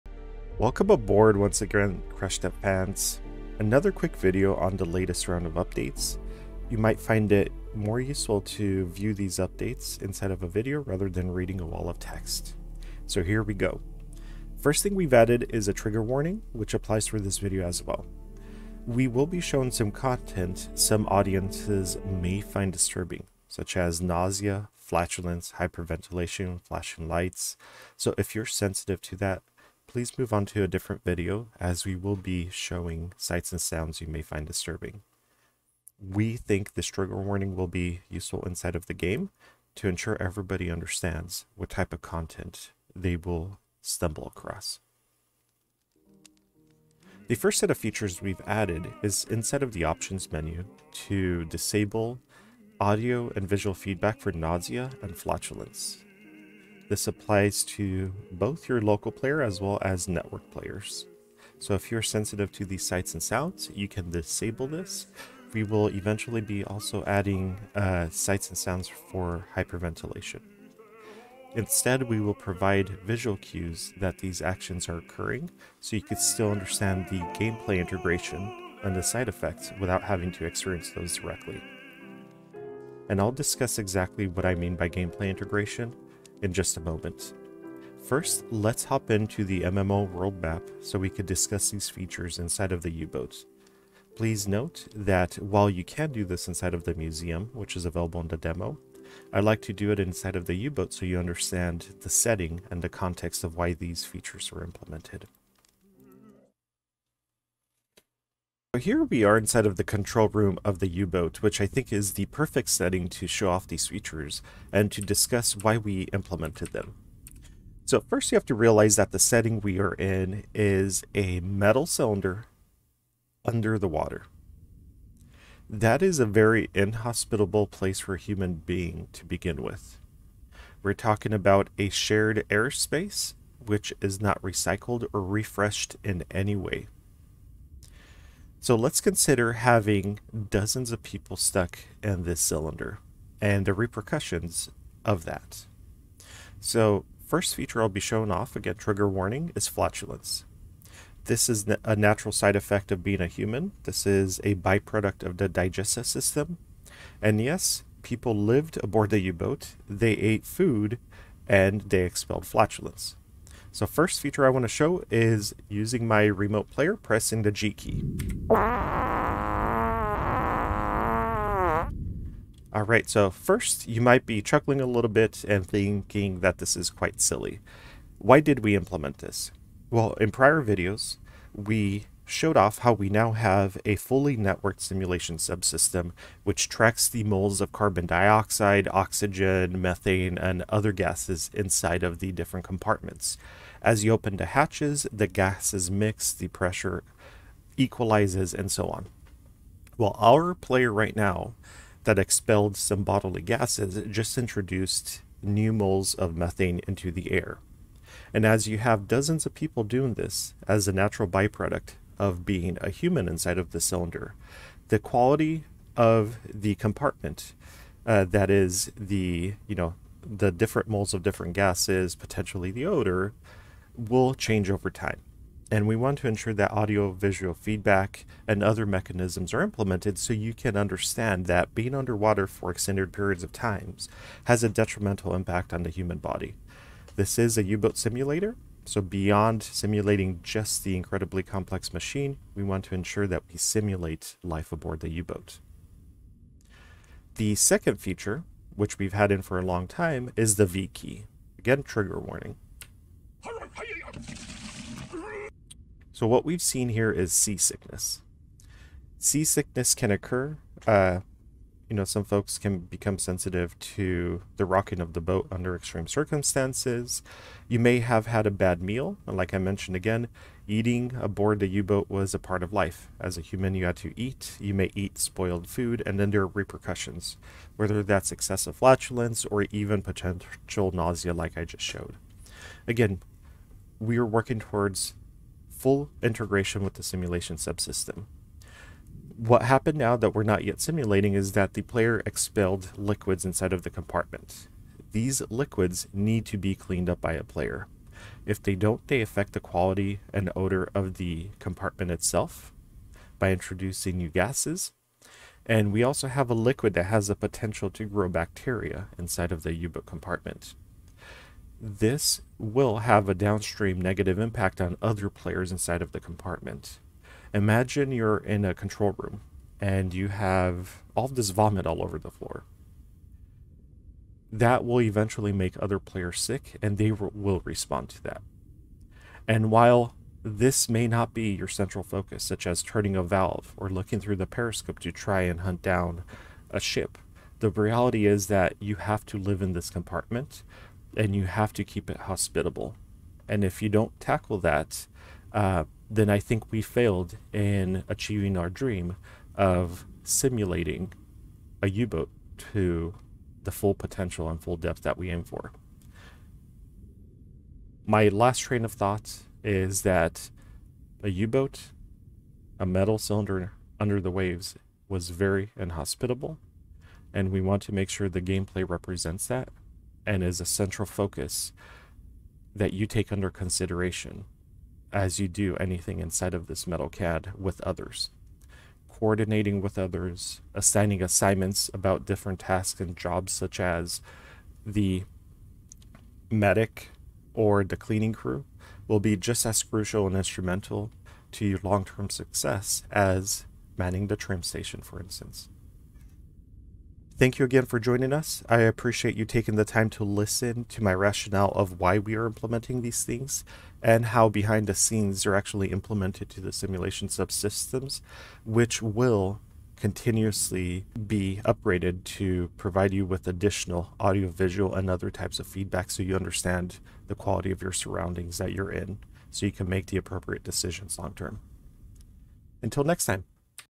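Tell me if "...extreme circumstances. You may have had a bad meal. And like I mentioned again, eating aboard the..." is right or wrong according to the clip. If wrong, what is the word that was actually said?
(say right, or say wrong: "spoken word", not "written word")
right.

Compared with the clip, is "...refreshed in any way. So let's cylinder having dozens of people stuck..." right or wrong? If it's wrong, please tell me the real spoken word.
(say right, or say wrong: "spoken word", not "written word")
wrong: "consider", not "cylinder".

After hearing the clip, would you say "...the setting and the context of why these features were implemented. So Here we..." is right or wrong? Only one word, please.
right.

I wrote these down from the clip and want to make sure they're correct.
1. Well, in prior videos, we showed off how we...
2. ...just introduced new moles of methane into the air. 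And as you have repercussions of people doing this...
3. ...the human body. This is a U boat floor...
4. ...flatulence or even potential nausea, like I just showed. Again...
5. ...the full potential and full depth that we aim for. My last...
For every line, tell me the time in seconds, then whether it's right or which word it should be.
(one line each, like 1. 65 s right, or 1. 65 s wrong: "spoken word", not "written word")
1. 179 s right
2. 204 s wrong: "dozens", not "repercussions"
3. 235 s wrong: "simulator", not "floor"
4. 278 s right
5. 353 s right.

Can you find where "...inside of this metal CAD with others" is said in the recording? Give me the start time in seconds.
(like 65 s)
376 s.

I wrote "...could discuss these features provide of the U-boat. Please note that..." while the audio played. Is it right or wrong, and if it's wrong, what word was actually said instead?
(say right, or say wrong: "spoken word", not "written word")
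wrong: "inside", not "provide".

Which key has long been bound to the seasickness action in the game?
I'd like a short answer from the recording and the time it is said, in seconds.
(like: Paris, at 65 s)
V, at 250 s.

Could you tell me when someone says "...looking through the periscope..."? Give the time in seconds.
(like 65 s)
333 s.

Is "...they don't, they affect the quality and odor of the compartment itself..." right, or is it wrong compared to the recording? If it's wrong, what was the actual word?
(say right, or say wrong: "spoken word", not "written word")
right.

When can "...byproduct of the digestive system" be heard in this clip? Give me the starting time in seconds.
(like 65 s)
154 s.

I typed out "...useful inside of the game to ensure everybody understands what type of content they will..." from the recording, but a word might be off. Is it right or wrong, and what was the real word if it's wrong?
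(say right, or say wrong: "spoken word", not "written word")
right.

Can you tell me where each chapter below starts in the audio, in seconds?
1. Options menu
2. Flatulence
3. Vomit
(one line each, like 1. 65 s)
1. 46 s
2. 146 s
3. 246 s.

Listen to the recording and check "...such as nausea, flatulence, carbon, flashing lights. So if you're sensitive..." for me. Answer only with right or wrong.
wrong.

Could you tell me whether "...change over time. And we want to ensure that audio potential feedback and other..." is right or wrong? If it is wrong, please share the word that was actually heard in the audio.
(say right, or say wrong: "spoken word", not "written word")
wrong: "visual", not "potential".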